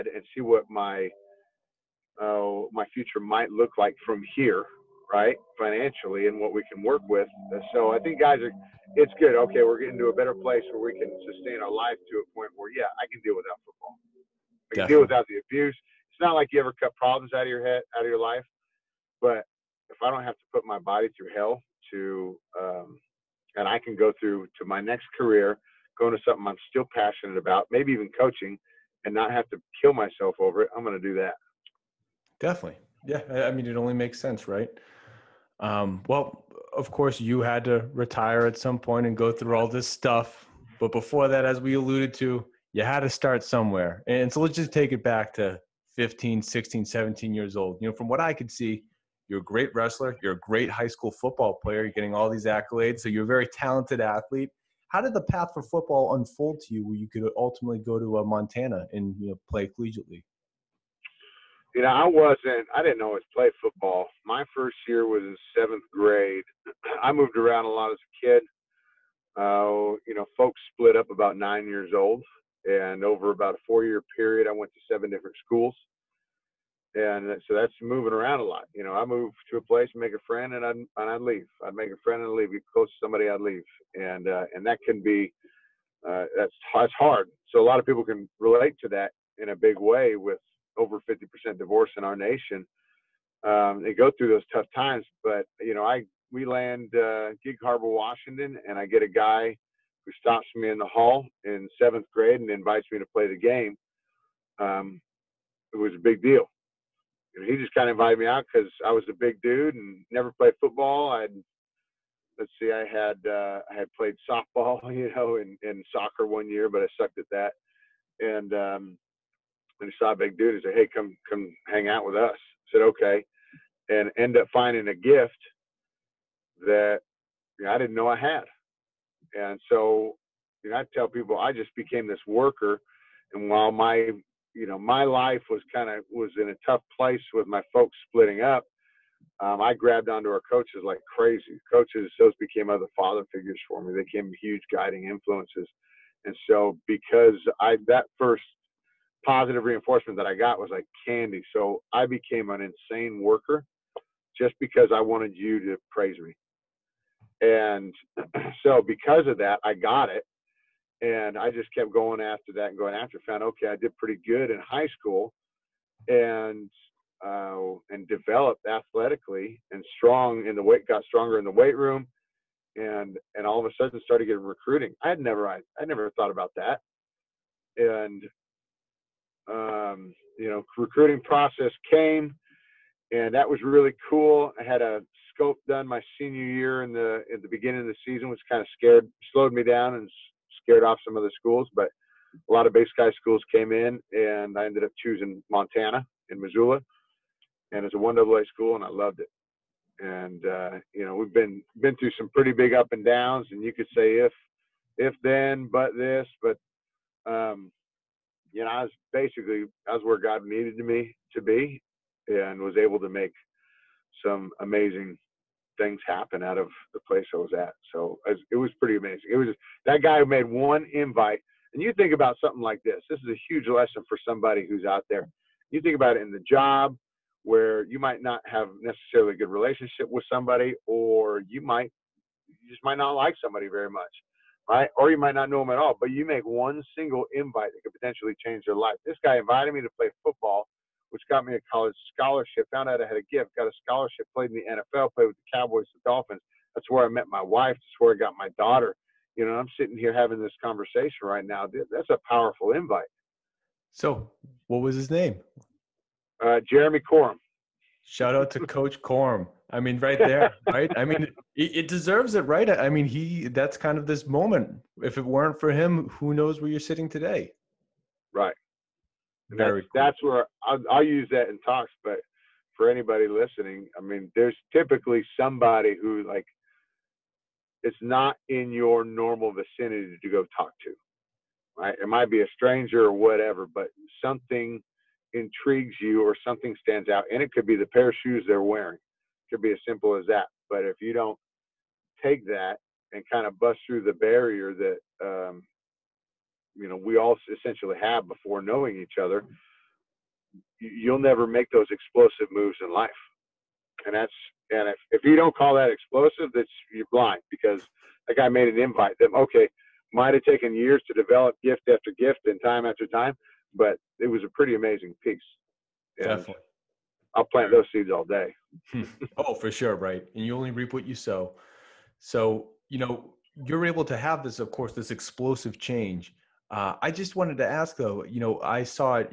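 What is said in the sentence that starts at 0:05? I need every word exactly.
Financially and what we can work with.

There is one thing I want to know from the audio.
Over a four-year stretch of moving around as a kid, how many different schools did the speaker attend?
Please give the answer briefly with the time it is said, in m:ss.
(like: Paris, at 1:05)
7, at 1:14.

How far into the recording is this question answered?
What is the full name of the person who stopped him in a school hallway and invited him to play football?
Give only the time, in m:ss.
4:16.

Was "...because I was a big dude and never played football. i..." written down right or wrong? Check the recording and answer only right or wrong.
right.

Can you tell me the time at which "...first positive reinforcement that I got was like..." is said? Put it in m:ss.
2:28.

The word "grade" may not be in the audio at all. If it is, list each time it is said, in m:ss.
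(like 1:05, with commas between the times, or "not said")
1:05, 1:42.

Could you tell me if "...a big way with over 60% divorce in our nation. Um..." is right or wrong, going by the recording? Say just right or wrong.
wrong.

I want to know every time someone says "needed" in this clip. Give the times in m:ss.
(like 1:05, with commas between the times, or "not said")
3:30.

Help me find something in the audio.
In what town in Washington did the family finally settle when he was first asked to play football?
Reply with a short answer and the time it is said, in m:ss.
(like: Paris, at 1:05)
Gig Harbor, at 1:37.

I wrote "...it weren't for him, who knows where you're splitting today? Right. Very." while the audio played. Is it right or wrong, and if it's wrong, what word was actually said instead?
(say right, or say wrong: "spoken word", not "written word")
wrong: "sitting", not "splitting".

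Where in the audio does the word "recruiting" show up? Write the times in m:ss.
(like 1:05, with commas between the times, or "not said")
2:54, 3:00.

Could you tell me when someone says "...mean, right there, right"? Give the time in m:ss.
4:19.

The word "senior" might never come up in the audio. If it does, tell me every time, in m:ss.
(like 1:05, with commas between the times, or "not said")
3:06.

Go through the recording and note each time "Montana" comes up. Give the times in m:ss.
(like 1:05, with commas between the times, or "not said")
0:58, 3:15.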